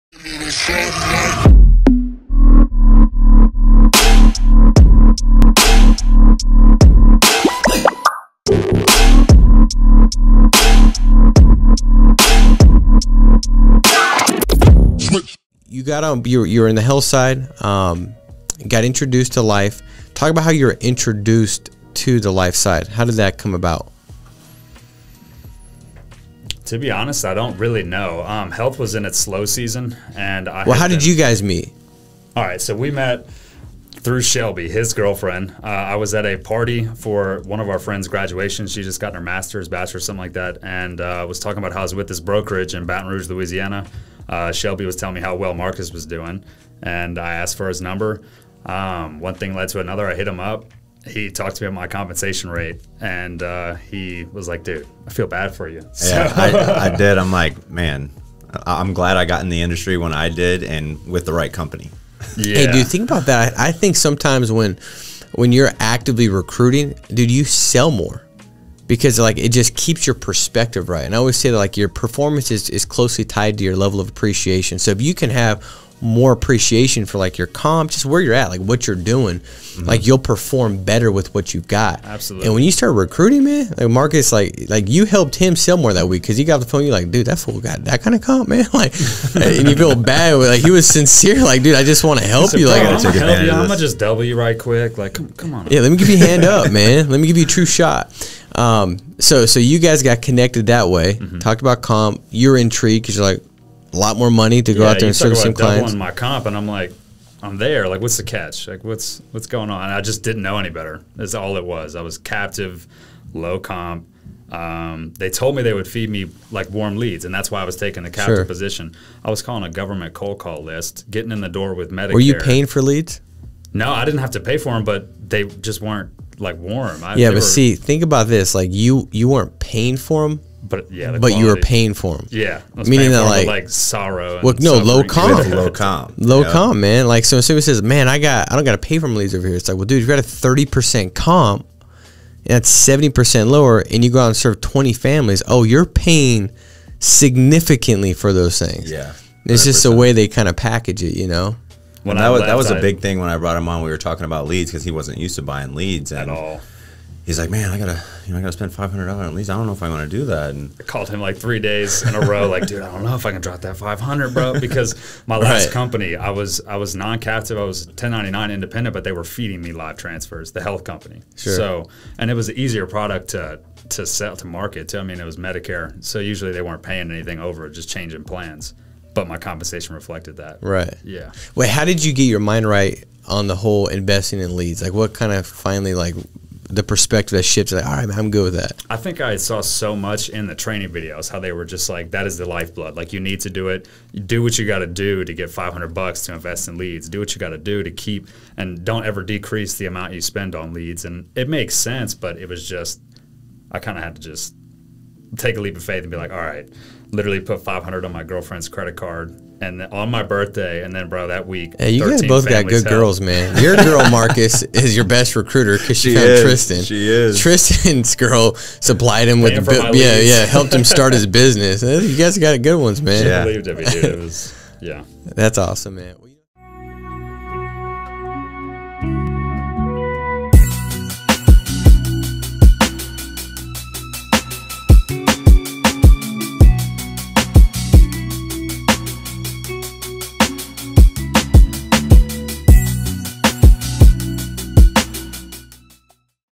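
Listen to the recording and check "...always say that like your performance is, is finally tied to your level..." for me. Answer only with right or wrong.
wrong.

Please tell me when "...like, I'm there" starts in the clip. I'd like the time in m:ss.
1:46.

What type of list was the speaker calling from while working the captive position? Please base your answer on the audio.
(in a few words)
government cold call list.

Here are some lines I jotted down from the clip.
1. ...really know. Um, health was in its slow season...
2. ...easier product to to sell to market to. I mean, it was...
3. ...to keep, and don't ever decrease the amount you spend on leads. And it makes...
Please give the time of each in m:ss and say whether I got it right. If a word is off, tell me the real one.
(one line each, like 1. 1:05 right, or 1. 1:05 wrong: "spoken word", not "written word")
1. 0:27 right
2. 2:52 right
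3. 3:17 right.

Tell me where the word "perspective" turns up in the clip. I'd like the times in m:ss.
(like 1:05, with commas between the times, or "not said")
1:10, 3:06.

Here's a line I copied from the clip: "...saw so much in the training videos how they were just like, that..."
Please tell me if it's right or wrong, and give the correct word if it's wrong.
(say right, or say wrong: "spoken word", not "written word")
right.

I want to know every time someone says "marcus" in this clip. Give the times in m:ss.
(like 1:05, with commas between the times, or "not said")
0:45, 1:23, 3:34.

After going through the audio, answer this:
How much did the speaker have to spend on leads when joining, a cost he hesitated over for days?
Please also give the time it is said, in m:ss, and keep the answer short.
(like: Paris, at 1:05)
$500, at 2:38.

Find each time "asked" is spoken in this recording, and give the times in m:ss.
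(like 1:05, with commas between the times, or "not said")
0:47.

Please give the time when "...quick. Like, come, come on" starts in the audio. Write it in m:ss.
1:34.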